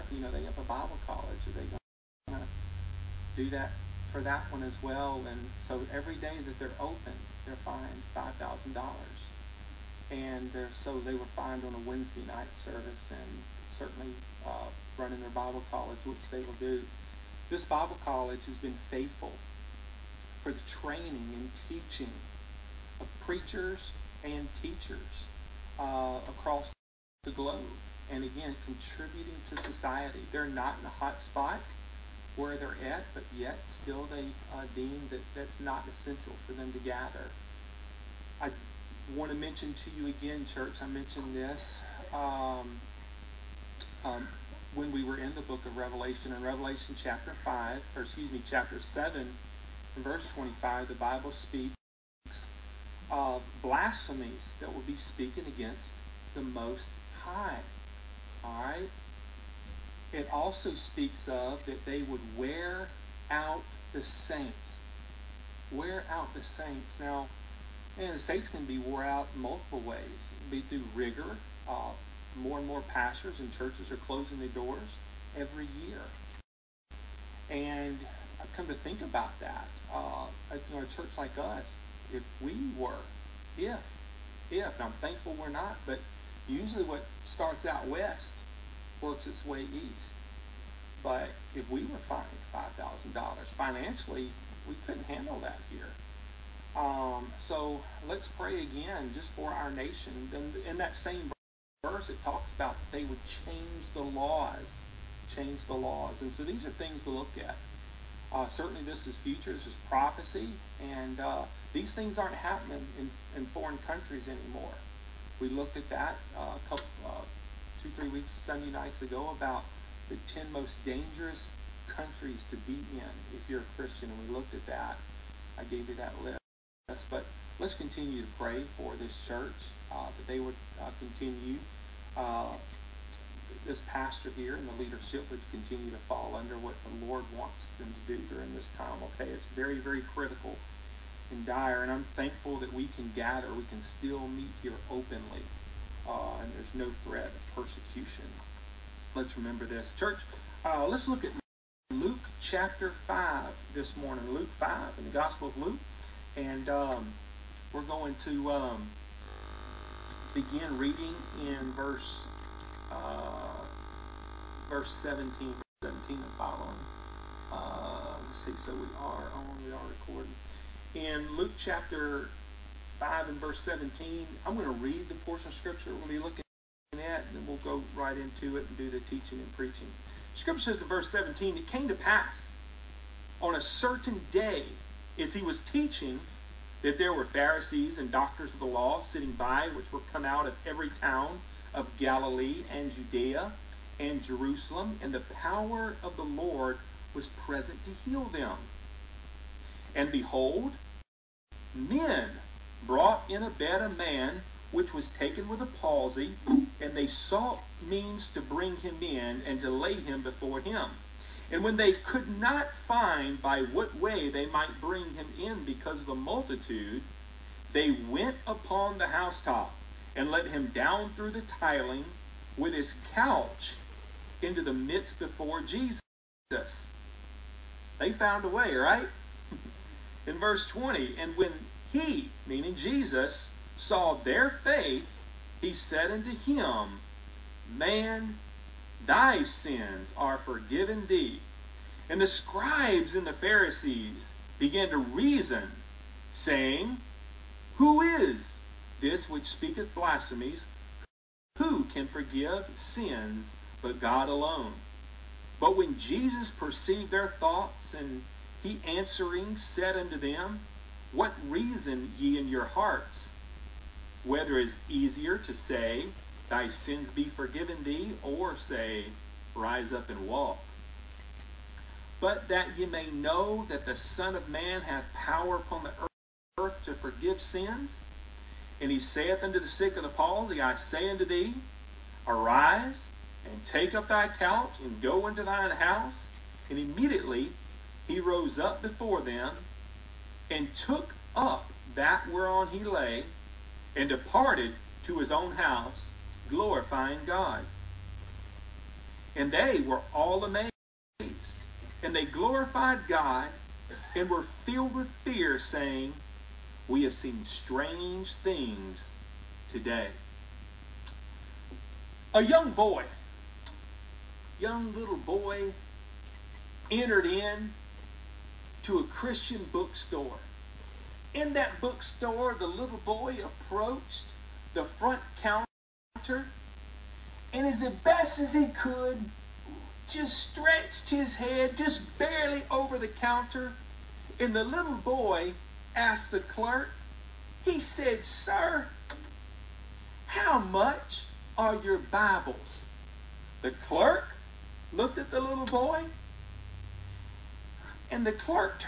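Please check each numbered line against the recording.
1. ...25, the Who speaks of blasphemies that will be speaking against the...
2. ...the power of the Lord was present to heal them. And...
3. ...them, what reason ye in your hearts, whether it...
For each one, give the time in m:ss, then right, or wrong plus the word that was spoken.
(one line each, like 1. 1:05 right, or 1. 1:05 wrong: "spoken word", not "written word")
1. 0:50 wrong: "Bible", not "Who"
2. 3:15 right
3. 4:20 right.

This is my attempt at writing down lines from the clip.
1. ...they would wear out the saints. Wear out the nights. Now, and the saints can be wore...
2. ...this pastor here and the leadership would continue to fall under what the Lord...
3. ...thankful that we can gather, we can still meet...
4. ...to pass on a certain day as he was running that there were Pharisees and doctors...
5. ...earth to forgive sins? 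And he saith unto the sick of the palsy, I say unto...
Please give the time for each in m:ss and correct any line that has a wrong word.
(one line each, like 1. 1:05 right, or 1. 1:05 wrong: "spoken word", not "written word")
1. 1:01 wrong: "saints", not "nights"
2. 2:13 right
3. 2:22 right
4. 3:01 wrong: "teaching", not "running"
5. 4:36 right.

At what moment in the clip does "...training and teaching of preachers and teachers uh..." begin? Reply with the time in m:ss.
0:20.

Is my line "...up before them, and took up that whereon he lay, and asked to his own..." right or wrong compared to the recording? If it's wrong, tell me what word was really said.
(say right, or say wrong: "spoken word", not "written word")
wrong: "departed", not "asked".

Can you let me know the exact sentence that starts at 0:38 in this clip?
I want to mention to you again, church, I mentioned this um, um, when we were in the book of Revelation.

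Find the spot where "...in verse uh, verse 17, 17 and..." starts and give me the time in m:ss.
2:41.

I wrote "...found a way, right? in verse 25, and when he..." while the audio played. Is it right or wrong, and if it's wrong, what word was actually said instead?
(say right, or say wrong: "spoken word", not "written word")
wrong: "20", not "25".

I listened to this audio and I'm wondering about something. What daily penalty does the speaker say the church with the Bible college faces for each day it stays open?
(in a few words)
$5,000.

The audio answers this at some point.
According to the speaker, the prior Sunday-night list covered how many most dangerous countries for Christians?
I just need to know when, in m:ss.
2:00.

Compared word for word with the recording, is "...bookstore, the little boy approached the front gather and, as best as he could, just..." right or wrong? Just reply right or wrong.
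wrong.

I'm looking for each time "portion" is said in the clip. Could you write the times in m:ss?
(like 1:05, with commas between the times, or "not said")
2:55.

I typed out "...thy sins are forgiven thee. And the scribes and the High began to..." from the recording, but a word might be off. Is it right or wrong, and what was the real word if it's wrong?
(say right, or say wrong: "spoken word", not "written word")
wrong: "Pharisees", not "High".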